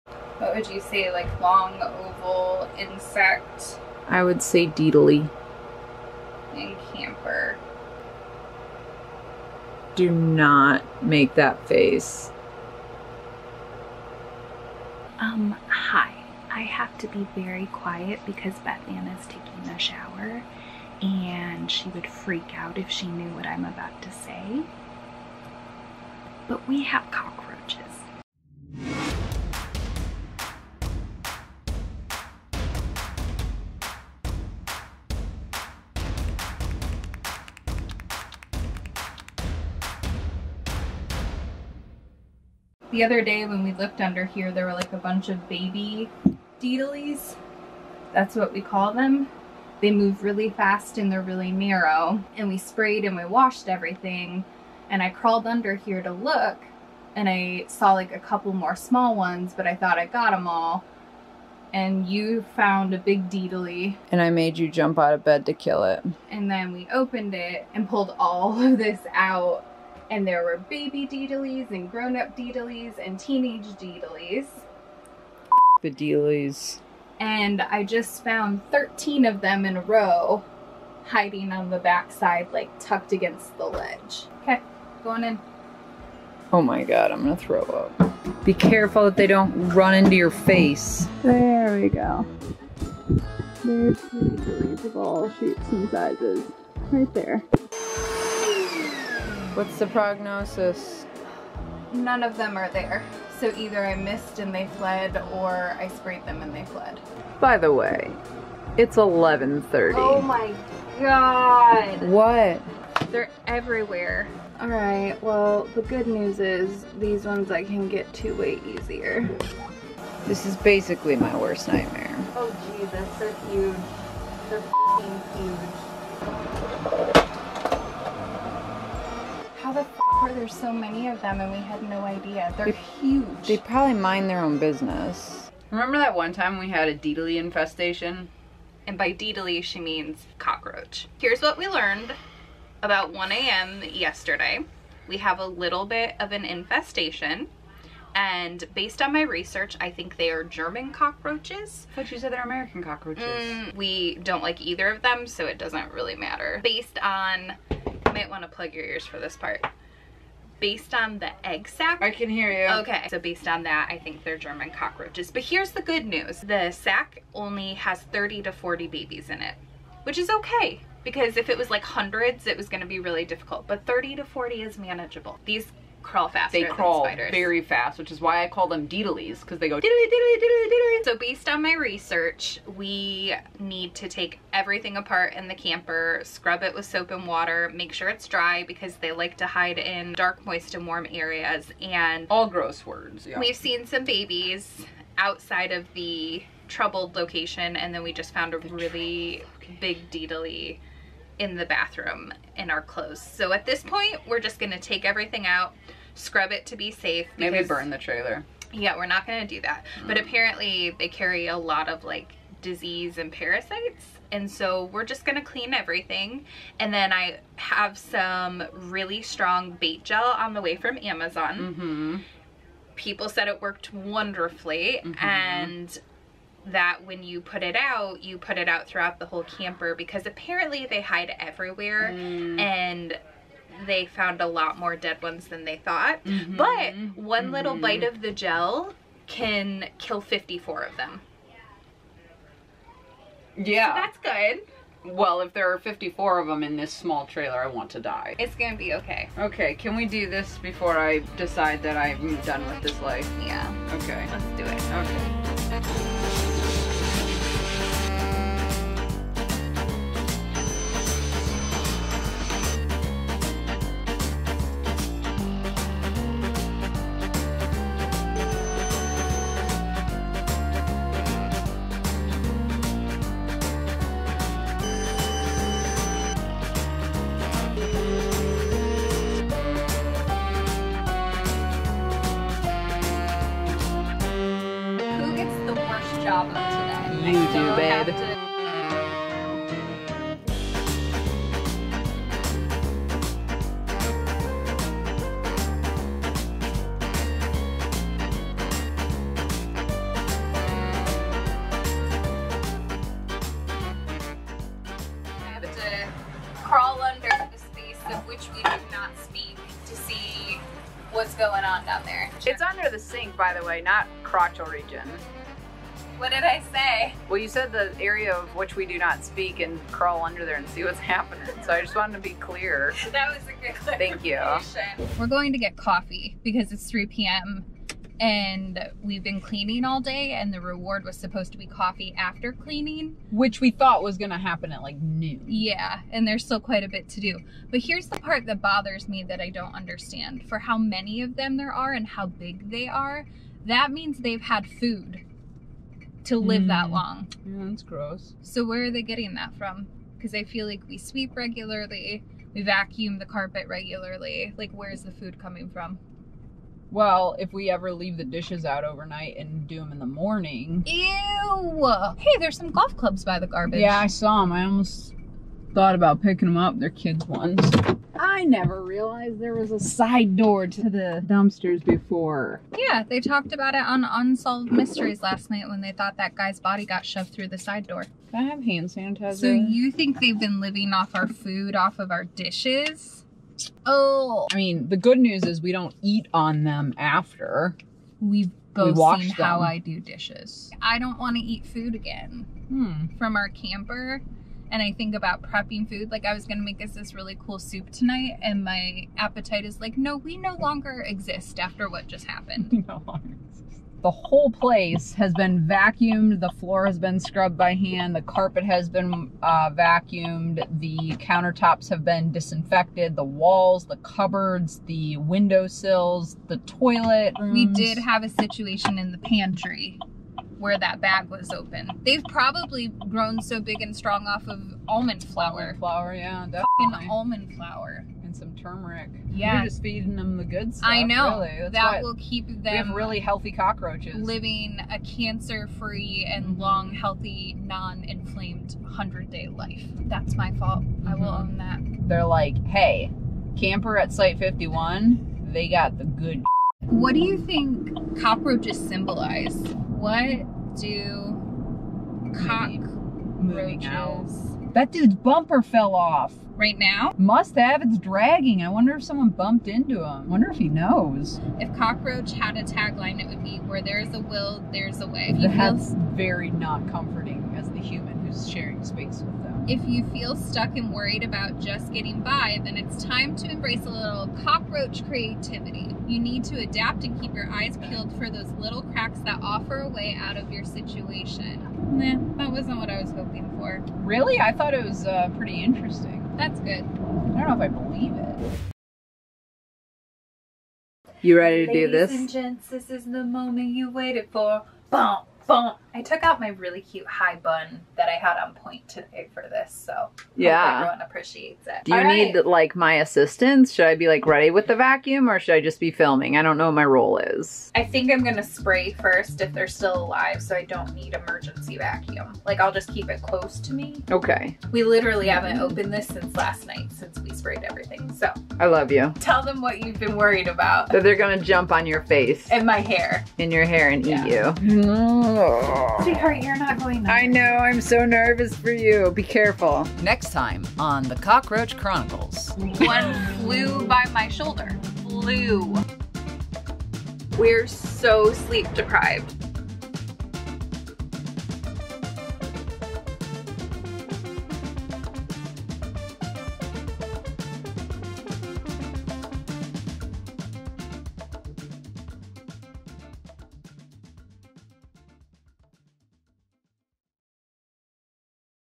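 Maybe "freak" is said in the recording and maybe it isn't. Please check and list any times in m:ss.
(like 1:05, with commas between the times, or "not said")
0:22.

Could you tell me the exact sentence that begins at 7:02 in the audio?
They've probably grown so big and strong off of almond flour.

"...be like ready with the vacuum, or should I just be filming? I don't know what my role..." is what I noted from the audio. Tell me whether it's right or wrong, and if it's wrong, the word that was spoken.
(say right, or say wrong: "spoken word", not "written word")
right.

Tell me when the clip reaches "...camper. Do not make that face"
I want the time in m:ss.
0:06.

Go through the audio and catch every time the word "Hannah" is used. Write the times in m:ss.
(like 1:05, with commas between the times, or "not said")
not said.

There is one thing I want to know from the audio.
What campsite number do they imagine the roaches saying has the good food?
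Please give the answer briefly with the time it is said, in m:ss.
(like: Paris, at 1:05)
51, at 7:23.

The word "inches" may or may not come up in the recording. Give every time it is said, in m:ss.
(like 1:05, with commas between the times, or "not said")
not said.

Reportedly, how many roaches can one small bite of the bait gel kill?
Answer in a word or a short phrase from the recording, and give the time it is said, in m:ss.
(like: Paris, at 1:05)
54, at 3:59.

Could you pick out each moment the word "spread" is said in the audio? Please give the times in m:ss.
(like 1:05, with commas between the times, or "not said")
not said.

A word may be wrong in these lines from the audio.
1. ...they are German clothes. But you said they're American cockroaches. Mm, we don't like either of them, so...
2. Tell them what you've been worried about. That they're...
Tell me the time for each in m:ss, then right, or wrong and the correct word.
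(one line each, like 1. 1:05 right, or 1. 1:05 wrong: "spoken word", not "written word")
1. 2:30 wrong: "cockroaches", not "clothes"
2. 8:39 right.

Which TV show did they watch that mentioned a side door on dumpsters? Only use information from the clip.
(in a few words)
Unsolved Mysteries.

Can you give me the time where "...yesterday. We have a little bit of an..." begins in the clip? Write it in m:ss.
2:23.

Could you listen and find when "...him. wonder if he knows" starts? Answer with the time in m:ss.
7:40.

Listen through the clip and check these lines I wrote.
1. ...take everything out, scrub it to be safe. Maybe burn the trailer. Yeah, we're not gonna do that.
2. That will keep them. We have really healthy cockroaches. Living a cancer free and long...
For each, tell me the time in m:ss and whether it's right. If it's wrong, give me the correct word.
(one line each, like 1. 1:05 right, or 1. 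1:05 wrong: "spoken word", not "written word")
1. 3:24 right
2. 7:11 right.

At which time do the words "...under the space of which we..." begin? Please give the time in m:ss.
5:07.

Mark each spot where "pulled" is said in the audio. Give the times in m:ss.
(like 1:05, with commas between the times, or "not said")
1:07.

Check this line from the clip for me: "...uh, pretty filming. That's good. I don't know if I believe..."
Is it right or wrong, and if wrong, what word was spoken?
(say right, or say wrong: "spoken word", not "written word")
wrong: "interesting", not "filming".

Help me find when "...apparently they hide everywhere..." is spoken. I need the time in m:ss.
3:50.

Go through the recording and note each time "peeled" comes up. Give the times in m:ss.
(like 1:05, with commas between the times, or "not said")
7:57.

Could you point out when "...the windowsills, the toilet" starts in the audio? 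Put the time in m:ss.
6:54.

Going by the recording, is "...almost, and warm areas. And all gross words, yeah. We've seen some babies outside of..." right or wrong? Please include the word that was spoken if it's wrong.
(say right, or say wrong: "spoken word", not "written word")
wrong: "moist", not "almost".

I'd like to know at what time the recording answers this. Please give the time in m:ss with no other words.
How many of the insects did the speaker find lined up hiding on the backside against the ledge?
1:18.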